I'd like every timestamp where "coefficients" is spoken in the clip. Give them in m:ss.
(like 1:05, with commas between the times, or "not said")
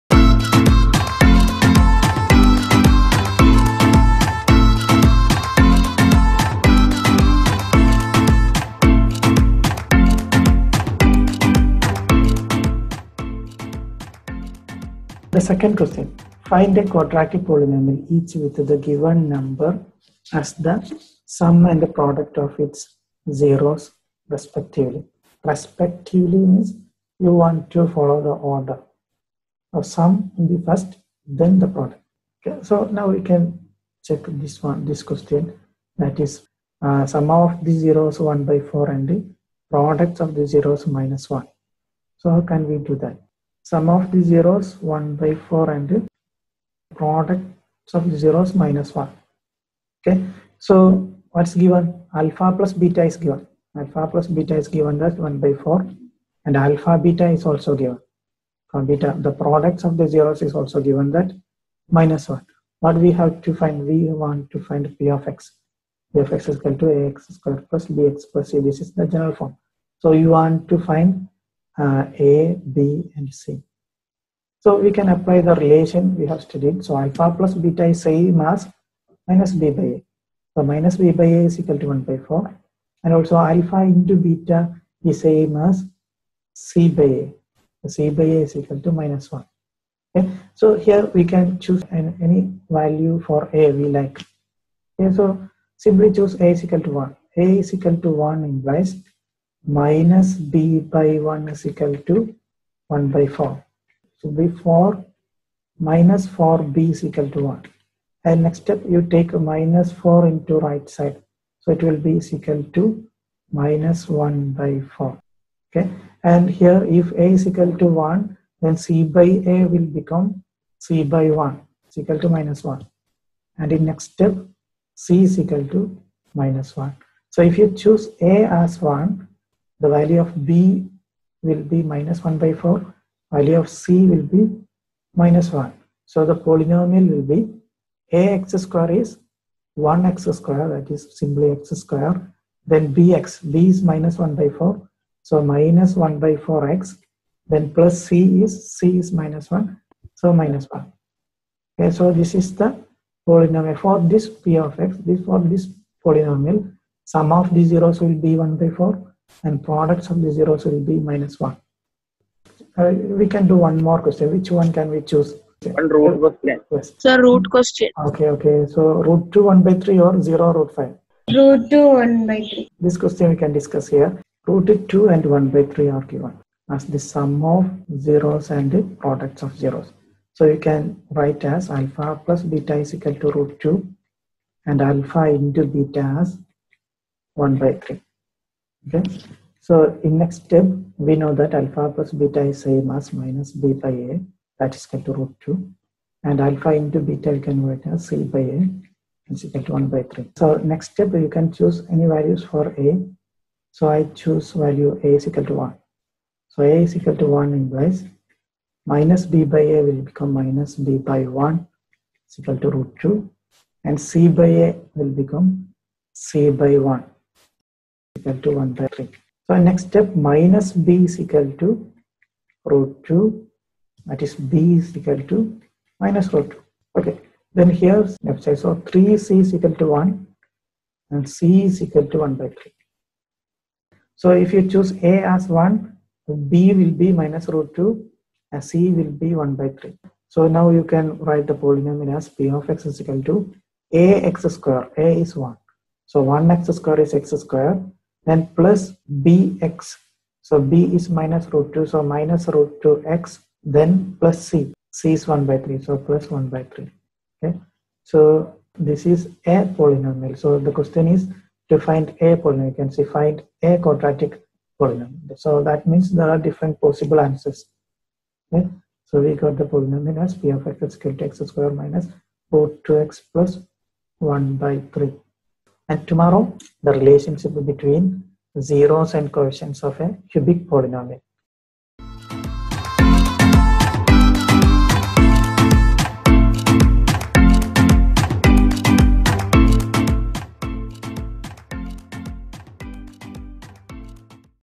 4:39.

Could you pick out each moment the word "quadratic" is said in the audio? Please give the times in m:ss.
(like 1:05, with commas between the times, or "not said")
0:16, 4:23.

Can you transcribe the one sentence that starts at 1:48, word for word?
And next step you take minus 4 into right side.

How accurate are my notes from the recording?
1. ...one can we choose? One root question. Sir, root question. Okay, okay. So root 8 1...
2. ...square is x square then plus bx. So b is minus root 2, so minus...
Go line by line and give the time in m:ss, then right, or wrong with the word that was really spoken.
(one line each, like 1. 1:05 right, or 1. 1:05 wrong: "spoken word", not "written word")
1. 2:44 wrong: "2", not "8"
2. 4:06 right.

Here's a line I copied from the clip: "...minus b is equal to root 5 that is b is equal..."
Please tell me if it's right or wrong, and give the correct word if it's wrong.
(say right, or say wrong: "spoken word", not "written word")
wrong: "2", not "5".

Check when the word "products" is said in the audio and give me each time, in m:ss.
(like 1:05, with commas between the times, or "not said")
0:21, 0:31, 0:39, 0:46, 0:59, 2:39, 2:59.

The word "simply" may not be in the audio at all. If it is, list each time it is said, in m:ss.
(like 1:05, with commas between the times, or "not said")
1:35, 2:21.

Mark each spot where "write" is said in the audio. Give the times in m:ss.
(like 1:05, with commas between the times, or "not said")
3:01, 3:17, 4:01.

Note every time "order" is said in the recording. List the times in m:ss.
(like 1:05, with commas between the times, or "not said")
0:28.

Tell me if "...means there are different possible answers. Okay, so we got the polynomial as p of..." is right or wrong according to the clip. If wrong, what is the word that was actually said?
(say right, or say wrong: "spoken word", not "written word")
right.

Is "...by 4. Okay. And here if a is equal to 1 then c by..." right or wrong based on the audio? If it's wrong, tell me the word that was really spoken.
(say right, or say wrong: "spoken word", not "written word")
right.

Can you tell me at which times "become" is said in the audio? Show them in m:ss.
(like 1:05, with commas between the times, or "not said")
1:59, 3:30, 3:35.